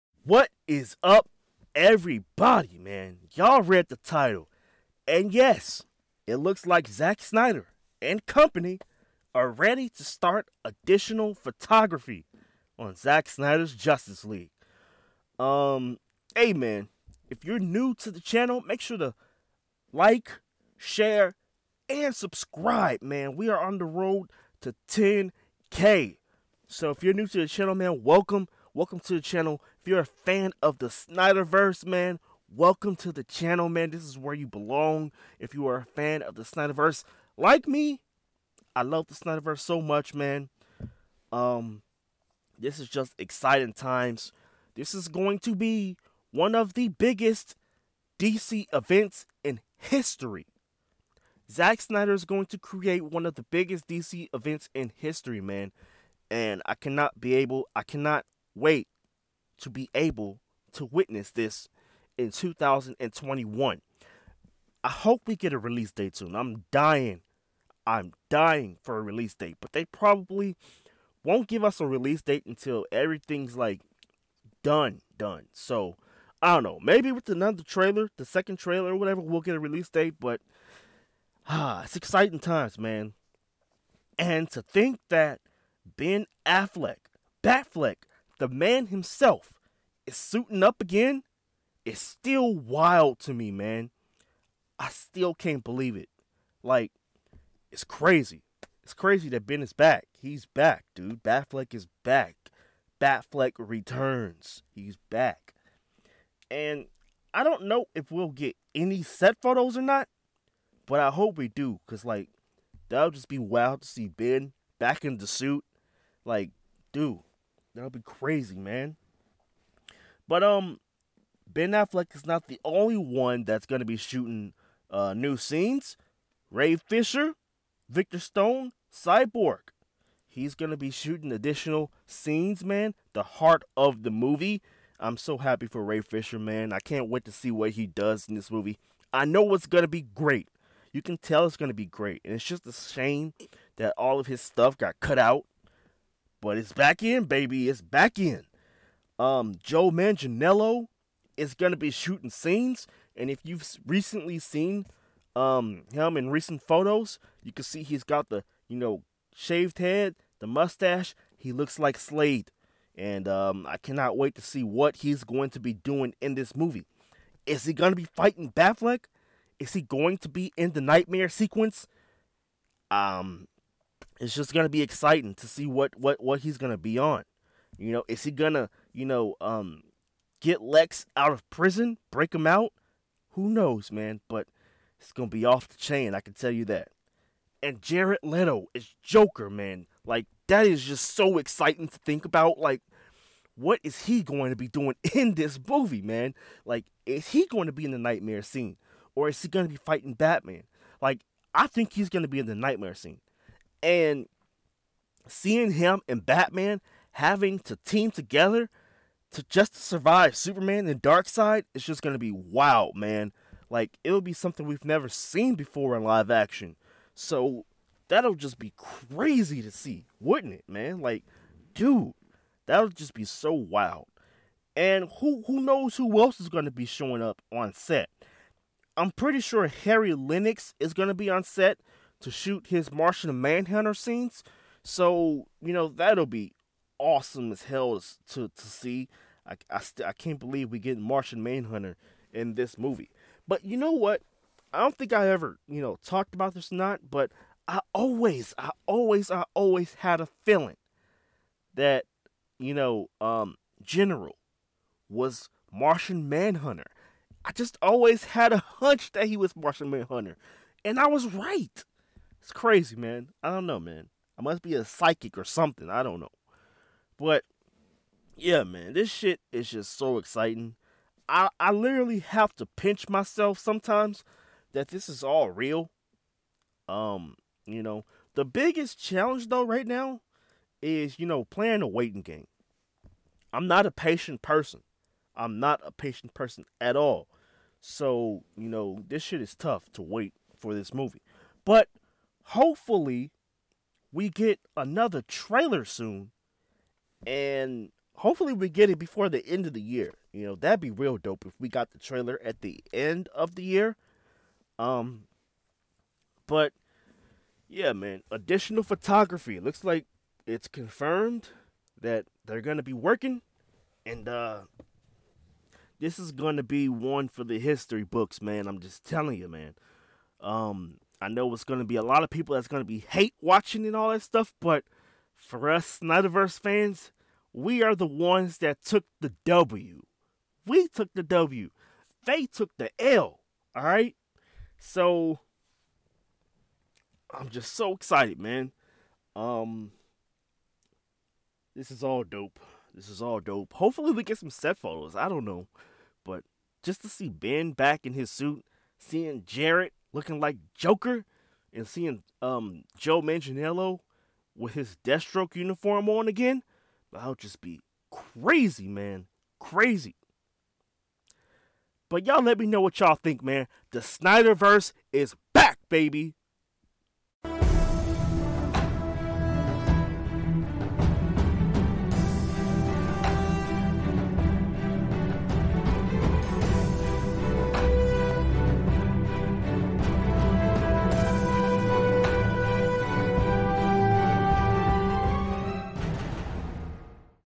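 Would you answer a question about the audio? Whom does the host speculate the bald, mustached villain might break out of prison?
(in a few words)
Lex.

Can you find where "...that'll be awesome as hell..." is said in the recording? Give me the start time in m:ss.
3:55.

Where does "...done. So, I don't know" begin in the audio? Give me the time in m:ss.
1:15.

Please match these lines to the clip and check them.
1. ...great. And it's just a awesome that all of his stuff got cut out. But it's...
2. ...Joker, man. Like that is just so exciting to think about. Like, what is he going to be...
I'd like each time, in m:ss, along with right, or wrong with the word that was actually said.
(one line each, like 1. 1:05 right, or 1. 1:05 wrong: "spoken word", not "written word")
1. 2:21 wrong: "shame", not "awesome"
2. 3:09 right.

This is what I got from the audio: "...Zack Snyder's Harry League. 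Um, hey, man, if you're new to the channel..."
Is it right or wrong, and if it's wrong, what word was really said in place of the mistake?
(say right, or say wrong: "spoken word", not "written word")
wrong: "Justice", not "Harry".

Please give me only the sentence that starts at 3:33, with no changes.
Like it'll be something we've never seen before in live action.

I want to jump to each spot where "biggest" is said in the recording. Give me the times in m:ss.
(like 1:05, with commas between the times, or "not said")
0:46, 0:53, 4:38.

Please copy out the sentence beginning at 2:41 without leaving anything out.
He looks like Slade, and um, I cannot wait to see what he's going to be doing in this movie.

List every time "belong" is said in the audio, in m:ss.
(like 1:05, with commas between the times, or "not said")
0:34.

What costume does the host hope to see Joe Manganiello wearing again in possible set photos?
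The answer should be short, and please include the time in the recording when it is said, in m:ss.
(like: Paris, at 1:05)
Deathstroke uniform, at 5:55.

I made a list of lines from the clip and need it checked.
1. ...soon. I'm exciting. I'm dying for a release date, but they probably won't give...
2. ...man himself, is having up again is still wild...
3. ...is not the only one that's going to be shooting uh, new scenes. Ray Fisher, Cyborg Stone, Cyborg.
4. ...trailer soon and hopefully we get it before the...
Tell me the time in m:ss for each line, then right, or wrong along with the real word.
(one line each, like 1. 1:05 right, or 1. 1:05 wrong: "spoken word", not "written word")
1. 1:06 wrong: "dying", not "exciting"
2. 1:28 wrong: "suiting", not "having"
3. 2:02 wrong: "Victor", not "Cyborg"
4. 4:55 right.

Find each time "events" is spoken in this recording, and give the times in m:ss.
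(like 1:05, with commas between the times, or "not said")
0:48, 0:54.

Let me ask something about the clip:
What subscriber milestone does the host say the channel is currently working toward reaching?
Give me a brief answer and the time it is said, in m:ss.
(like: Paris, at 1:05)
10K, at 0:24.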